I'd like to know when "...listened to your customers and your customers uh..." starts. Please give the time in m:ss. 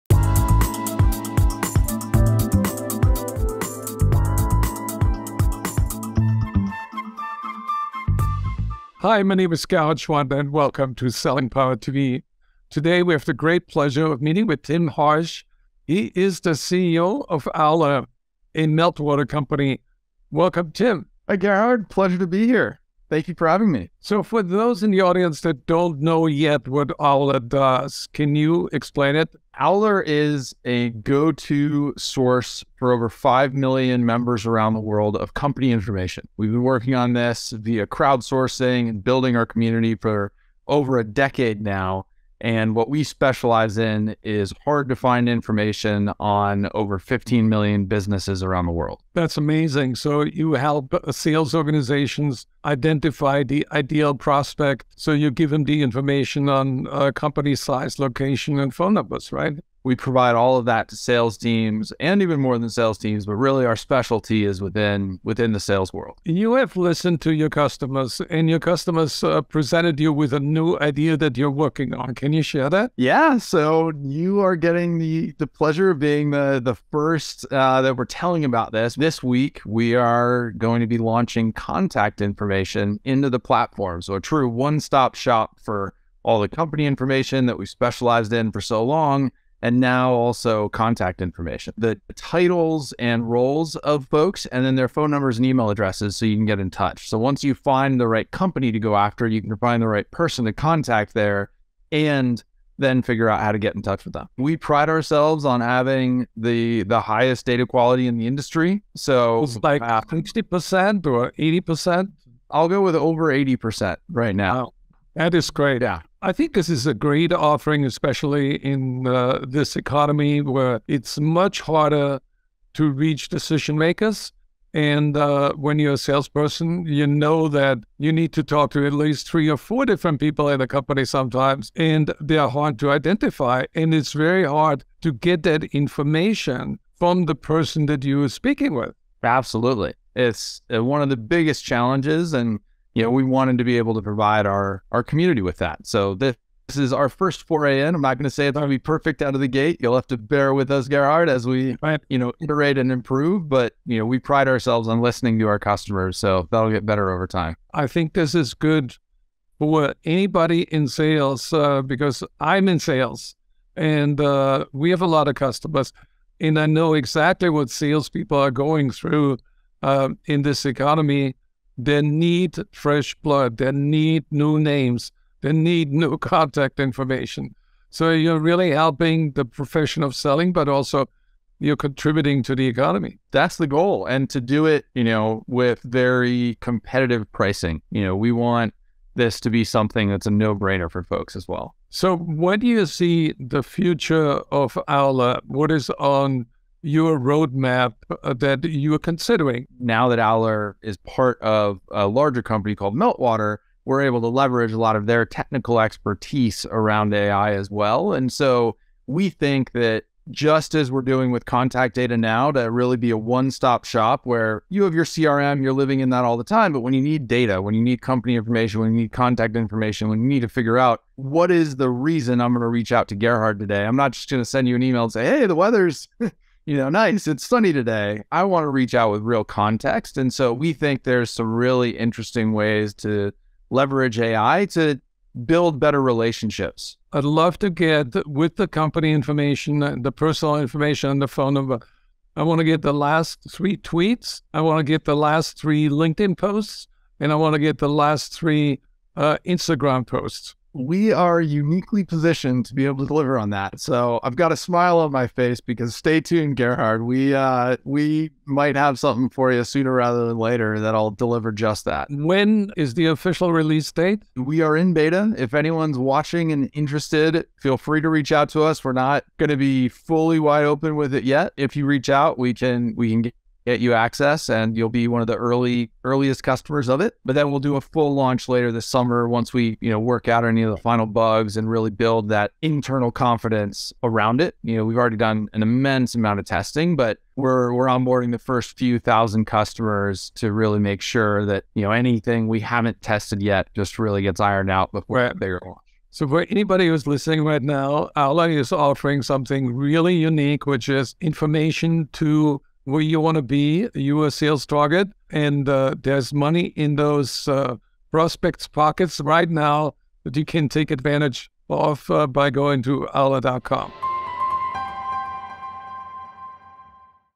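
1:06.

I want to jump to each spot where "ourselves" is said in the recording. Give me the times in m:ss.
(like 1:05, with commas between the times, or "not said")
1:44, 2:34.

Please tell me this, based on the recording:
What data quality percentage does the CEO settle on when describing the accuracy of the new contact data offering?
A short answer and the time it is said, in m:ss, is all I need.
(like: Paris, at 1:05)
over 80 percent, at 1:52.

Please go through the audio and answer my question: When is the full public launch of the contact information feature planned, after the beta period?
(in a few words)
later this summer.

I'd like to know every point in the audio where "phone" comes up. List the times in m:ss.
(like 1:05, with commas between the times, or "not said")
0:58, 1:34, 4:01.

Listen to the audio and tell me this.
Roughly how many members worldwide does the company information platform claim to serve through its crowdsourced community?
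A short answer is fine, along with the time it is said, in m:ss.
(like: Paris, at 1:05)
over 5 million, at 0:32.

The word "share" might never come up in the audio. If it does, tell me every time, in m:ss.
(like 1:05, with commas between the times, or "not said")
1:12.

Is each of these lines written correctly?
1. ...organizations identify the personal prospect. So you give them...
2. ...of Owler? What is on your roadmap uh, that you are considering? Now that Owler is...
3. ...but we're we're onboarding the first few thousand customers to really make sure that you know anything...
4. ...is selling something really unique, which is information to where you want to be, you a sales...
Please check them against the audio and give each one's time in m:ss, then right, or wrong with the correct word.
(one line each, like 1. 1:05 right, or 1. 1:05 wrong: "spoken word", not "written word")
1. 0:51 wrong: "ideal", not "personal"
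2. 3:14 right
3. 4:46 right
4. 4:58 wrong: "offering", not "selling".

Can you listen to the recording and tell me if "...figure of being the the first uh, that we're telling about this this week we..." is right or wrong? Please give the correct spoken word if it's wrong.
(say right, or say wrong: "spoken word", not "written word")
wrong: "pleasure", not "figure".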